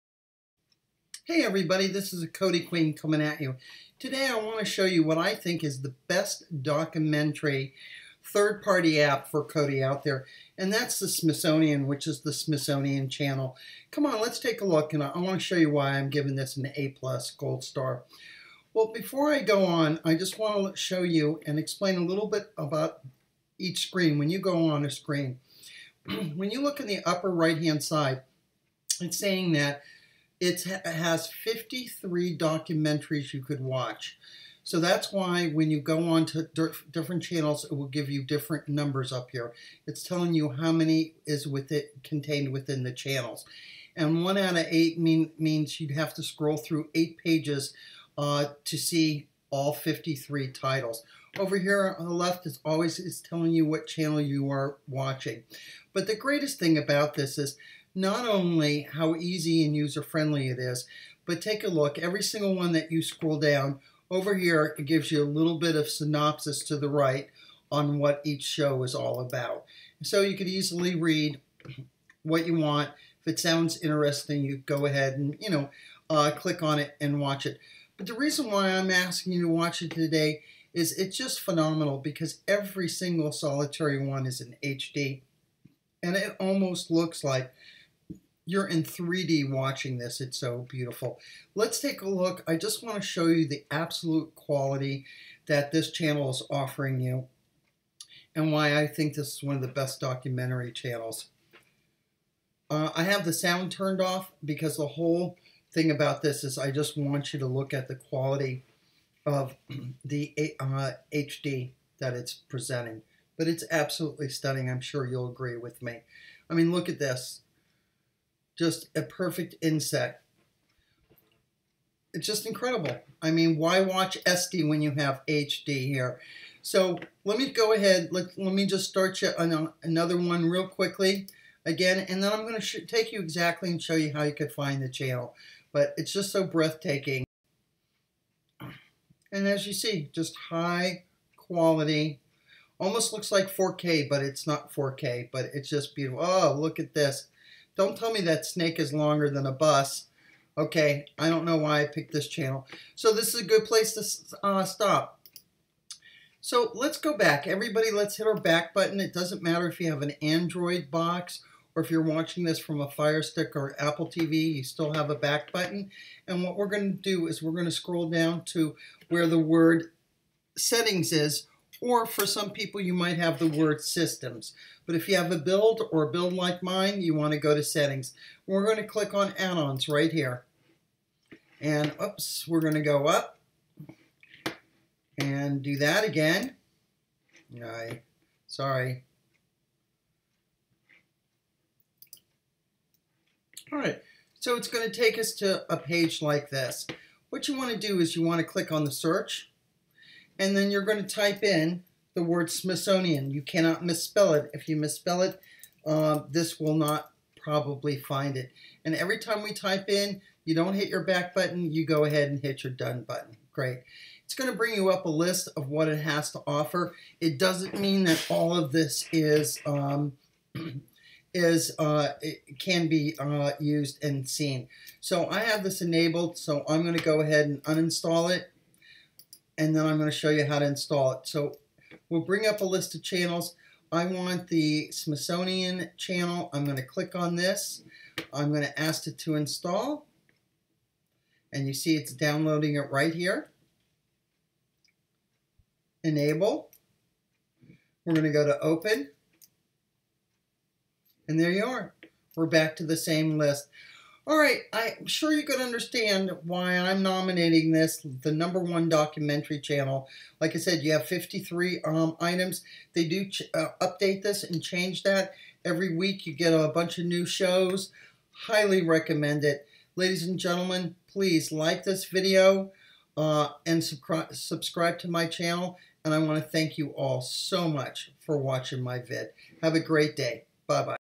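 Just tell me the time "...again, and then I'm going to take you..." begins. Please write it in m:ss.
2:11.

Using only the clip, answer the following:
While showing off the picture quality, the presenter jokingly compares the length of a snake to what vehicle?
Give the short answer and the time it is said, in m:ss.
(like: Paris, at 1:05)
A bus, at 2:29.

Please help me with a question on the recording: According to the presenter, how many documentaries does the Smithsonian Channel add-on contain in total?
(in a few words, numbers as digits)
53.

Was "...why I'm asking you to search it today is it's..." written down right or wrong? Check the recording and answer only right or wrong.
wrong.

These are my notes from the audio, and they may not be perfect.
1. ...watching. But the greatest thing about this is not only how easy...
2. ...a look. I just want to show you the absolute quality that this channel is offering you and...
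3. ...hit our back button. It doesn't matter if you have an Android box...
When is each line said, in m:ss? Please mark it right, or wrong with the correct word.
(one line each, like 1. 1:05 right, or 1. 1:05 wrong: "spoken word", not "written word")
1. 0:54 right
2. 1:32 right
3. 2:38 right.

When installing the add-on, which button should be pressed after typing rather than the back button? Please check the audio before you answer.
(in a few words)
Done.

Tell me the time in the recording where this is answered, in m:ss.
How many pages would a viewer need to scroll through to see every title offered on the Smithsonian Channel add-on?
0:44.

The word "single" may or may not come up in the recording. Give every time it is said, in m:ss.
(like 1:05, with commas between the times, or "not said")
1:02, 1:22.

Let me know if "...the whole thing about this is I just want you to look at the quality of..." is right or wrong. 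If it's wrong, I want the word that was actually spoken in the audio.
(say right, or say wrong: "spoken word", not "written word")
right.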